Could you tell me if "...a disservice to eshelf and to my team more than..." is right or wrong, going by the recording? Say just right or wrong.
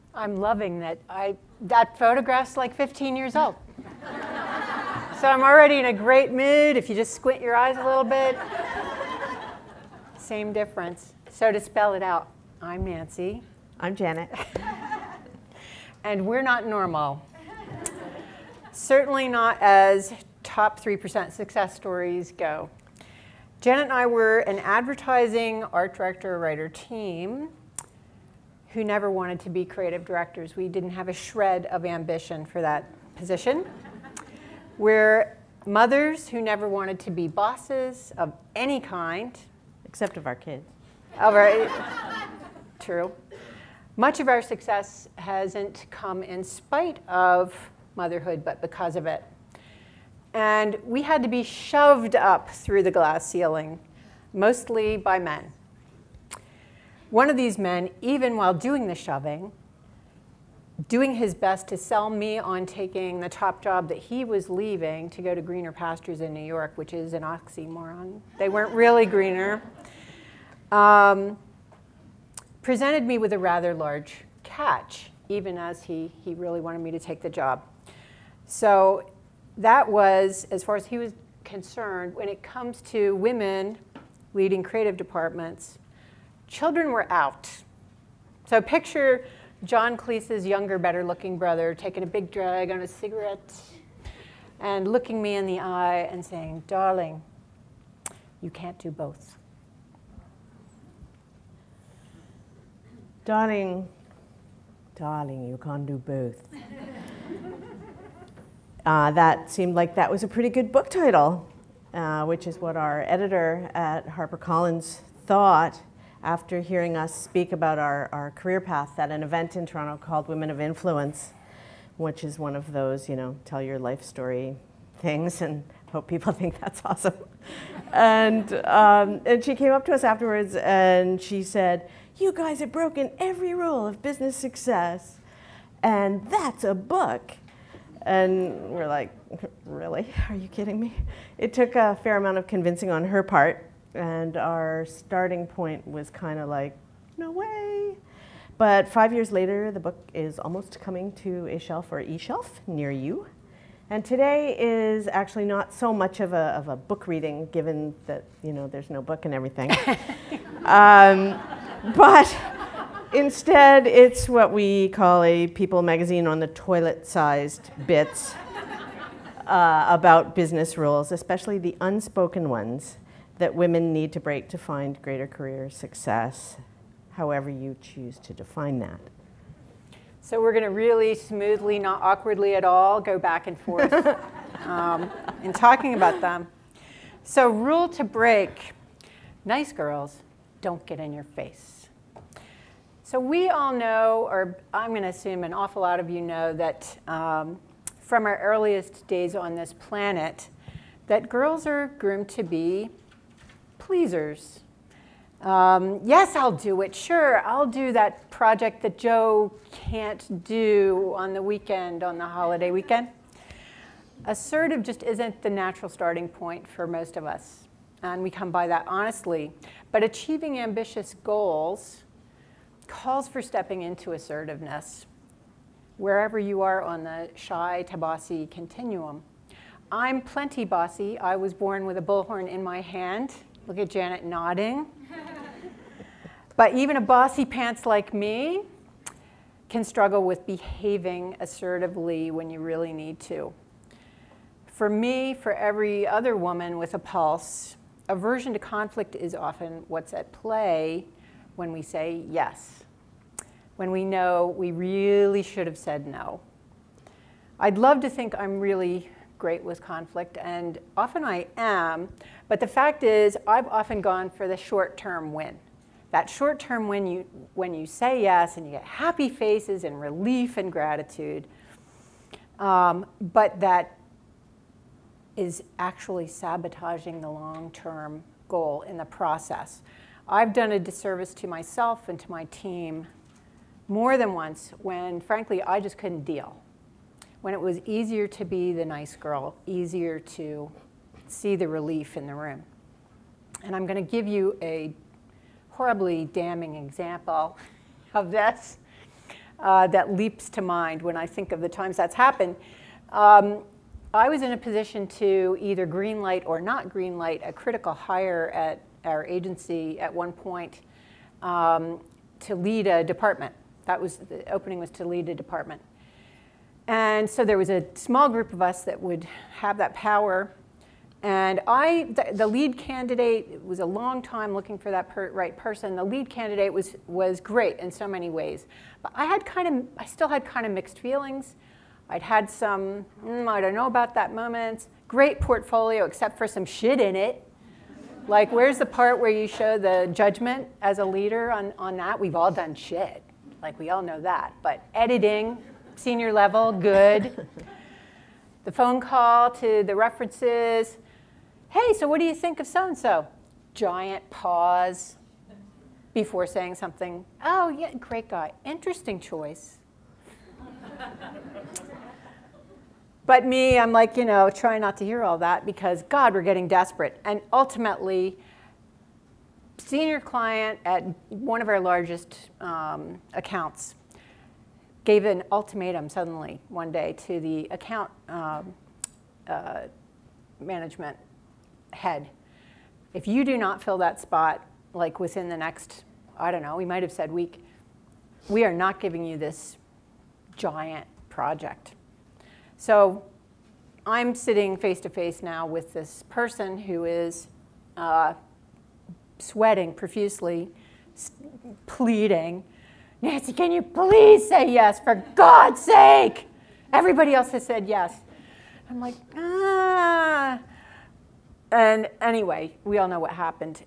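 wrong.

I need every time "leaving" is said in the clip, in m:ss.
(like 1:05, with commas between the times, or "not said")
1:04.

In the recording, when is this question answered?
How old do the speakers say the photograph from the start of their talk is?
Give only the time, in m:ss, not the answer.
0:02.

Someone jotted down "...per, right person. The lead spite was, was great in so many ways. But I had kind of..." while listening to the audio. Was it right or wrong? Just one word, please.
wrong.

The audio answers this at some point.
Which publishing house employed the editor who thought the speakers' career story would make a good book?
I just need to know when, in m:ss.
1:54.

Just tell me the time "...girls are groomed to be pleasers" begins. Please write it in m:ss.
3:21.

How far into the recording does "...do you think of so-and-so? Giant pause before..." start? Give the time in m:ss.
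5:52.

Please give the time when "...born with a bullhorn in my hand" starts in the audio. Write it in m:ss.
3:51.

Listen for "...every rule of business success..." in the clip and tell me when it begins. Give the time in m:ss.
2:13.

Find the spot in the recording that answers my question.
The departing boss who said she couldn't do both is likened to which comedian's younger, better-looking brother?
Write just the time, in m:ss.
1:29.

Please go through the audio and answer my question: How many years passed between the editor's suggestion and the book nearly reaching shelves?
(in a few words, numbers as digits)
5 years.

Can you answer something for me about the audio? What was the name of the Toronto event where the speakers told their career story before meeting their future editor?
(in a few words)
Women of Influence.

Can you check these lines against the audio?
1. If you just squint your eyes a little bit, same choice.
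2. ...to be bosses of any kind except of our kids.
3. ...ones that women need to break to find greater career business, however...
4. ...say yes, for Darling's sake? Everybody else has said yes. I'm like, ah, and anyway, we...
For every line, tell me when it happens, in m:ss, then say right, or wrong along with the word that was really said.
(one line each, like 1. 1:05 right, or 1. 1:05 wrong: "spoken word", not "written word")
1. 0:06 wrong: "difference", not "choice"
2. 0:36 right
3. 2:52 wrong: "success", not "business"
4. 6:44 wrong: "God", not "Darling".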